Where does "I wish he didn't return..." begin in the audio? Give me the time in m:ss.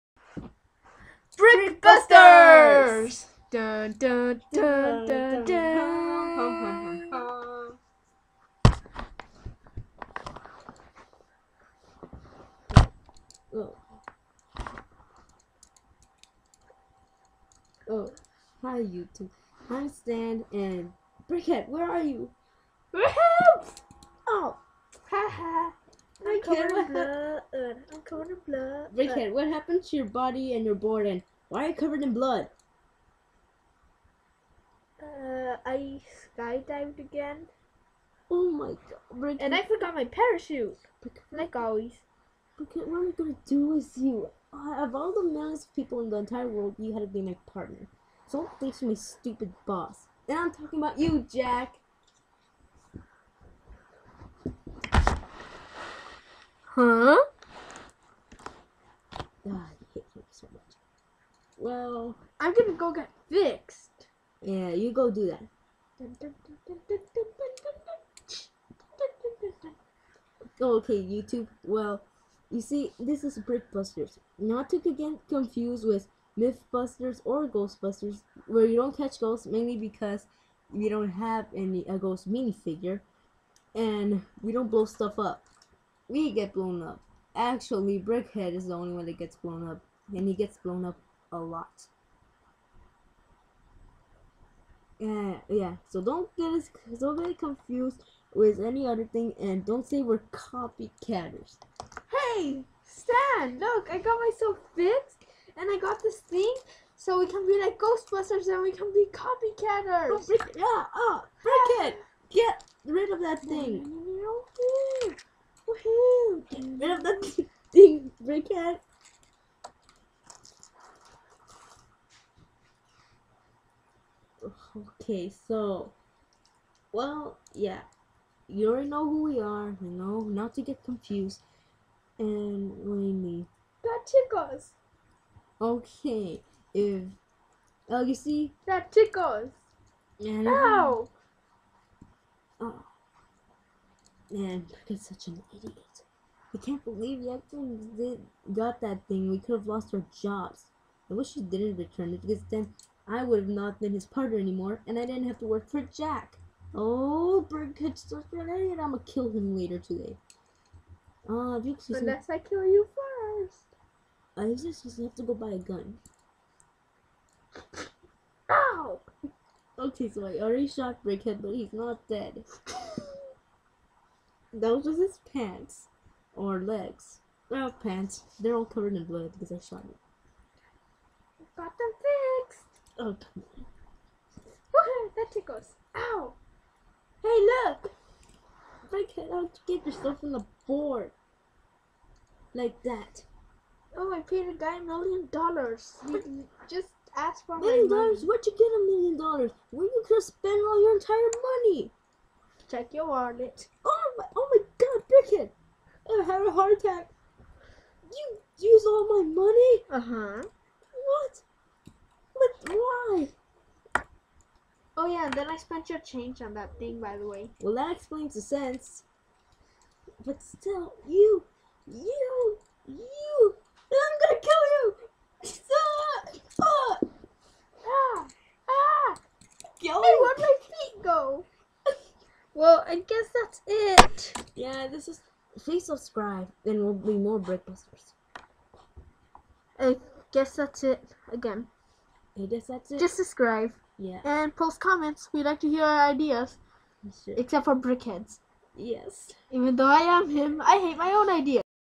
2:31.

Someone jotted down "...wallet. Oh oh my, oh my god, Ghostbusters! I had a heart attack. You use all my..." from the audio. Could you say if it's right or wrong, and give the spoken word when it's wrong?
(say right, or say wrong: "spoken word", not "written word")
wrong: "Brickhead", not "Ghostbusters".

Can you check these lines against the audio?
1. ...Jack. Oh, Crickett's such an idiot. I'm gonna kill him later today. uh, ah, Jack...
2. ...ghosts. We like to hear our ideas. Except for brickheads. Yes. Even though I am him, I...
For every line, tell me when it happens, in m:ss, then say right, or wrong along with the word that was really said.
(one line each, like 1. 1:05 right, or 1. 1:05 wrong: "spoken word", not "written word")
1. 2:35 wrong: "Unless", not "Jack"
2. 4:04 wrong: "comments", not "ghosts".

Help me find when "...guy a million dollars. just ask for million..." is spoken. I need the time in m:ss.
3:14.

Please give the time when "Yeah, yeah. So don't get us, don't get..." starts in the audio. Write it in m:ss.
1:34.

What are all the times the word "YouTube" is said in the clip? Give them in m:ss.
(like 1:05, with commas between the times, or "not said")
0:18, 1:11.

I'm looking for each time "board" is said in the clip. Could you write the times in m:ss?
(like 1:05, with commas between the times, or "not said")
0:30, 3:10.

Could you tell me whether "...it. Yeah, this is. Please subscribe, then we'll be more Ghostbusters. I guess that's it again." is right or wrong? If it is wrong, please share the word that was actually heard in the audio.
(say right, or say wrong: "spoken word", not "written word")
wrong: "Brickbusters", not "Ghostbusters".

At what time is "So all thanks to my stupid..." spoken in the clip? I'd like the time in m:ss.
0:48.